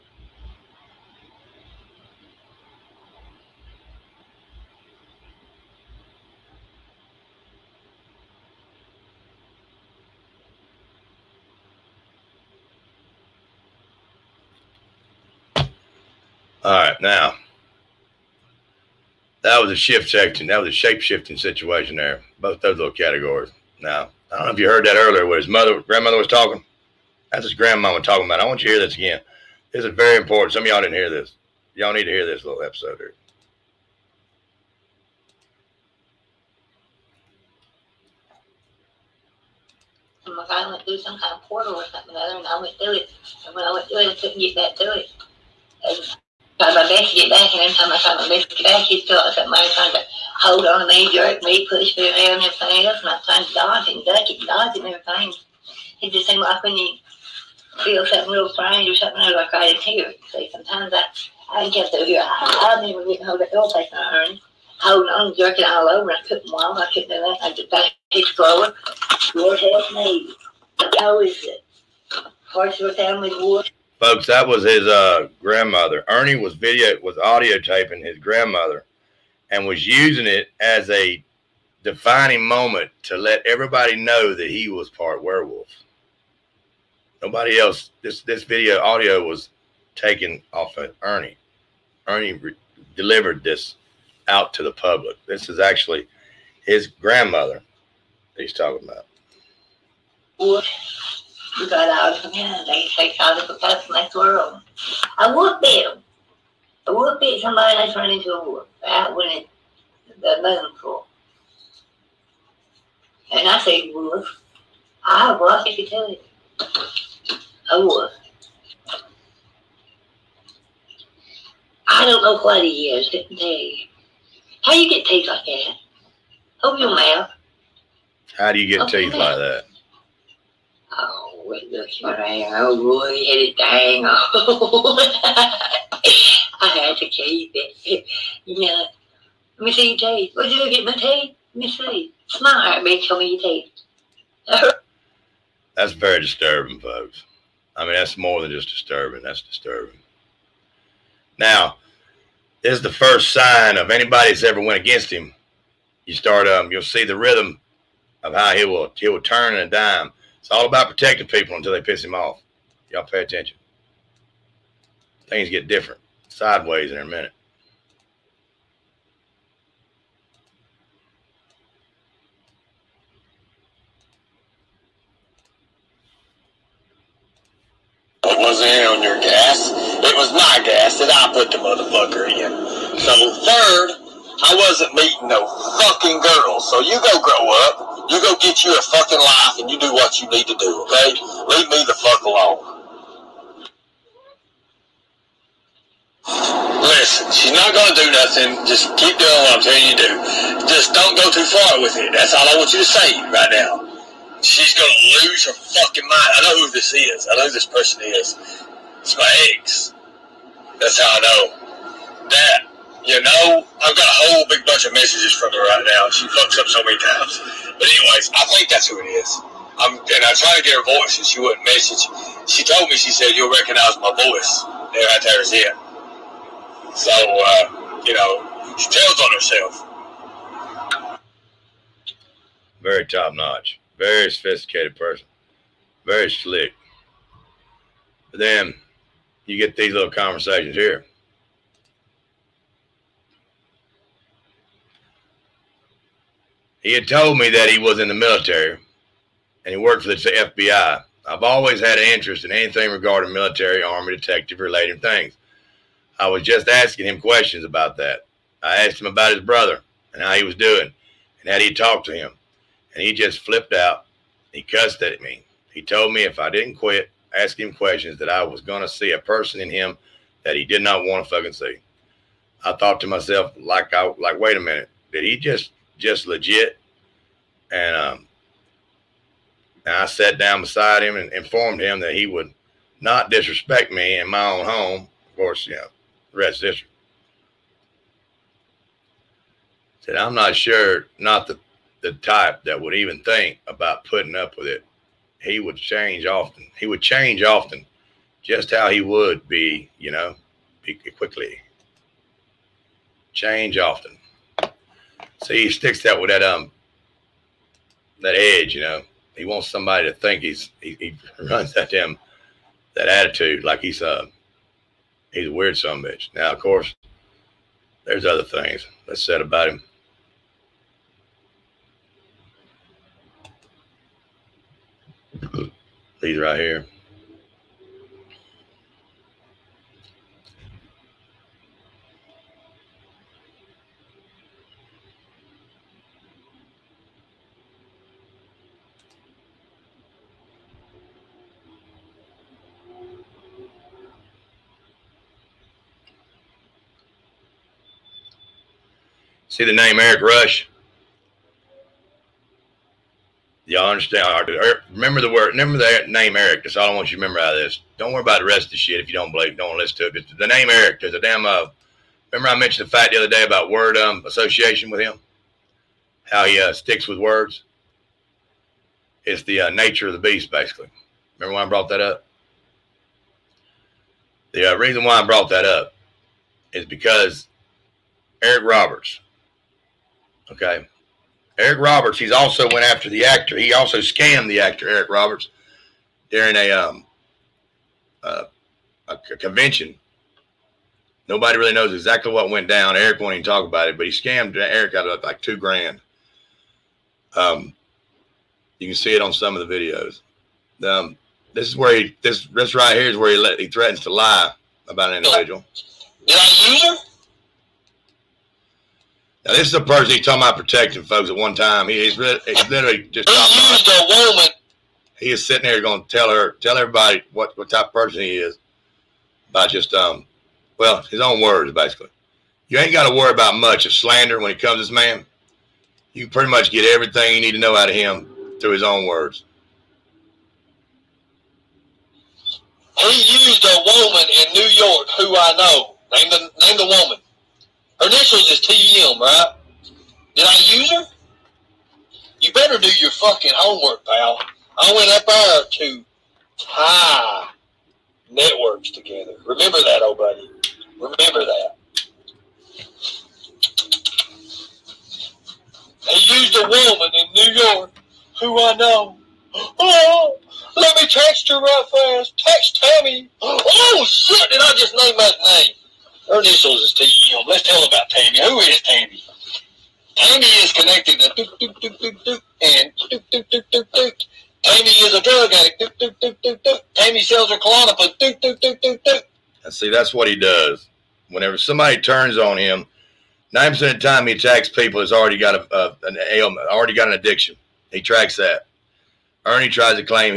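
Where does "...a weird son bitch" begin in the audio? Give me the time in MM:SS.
05:15.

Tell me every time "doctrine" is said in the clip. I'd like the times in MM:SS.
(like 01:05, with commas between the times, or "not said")
not said.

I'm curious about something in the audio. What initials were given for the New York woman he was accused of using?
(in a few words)
TM.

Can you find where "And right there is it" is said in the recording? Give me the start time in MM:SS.
03:44.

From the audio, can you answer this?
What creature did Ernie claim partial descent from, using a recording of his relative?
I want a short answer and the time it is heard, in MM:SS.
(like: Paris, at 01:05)
werewolf, at 01:25.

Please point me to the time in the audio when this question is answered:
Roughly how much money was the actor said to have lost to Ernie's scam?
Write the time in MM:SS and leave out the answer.
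06:35.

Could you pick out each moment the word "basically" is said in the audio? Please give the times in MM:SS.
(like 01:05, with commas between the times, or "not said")
06:10, 07:01.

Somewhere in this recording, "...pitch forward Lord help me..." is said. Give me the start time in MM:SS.
01:08.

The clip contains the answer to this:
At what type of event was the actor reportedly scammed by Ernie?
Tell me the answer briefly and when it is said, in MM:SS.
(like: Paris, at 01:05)
a convention, at 06:29.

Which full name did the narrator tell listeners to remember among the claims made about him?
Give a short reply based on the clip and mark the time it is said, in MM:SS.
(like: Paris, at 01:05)
Eric Rush, at 05:49.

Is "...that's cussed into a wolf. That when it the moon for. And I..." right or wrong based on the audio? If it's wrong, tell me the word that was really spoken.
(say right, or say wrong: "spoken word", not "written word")
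wrong: "turned", not "cussed".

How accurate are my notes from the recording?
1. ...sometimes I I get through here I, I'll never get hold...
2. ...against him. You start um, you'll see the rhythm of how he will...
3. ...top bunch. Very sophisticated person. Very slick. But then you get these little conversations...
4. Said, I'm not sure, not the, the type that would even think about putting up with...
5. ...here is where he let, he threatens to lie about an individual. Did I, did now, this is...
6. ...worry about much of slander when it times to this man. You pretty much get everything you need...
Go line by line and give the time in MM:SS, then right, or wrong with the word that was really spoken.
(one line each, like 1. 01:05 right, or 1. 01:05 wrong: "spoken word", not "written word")
1. 01:00 right
2. 02:34 right
3. 03:53 wrong: "notch", not "bunch"
4. 04:49 right
5. 06:42 right
6. 07:03 wrong: "comes", not "times".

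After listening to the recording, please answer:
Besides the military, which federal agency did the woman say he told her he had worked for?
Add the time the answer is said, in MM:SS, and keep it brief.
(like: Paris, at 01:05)
FBI, at 04:10.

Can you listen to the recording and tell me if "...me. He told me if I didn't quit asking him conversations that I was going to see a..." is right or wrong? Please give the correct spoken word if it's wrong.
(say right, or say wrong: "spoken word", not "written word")
wrong: "questions", not "conversations".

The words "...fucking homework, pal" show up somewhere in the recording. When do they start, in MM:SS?
07:23.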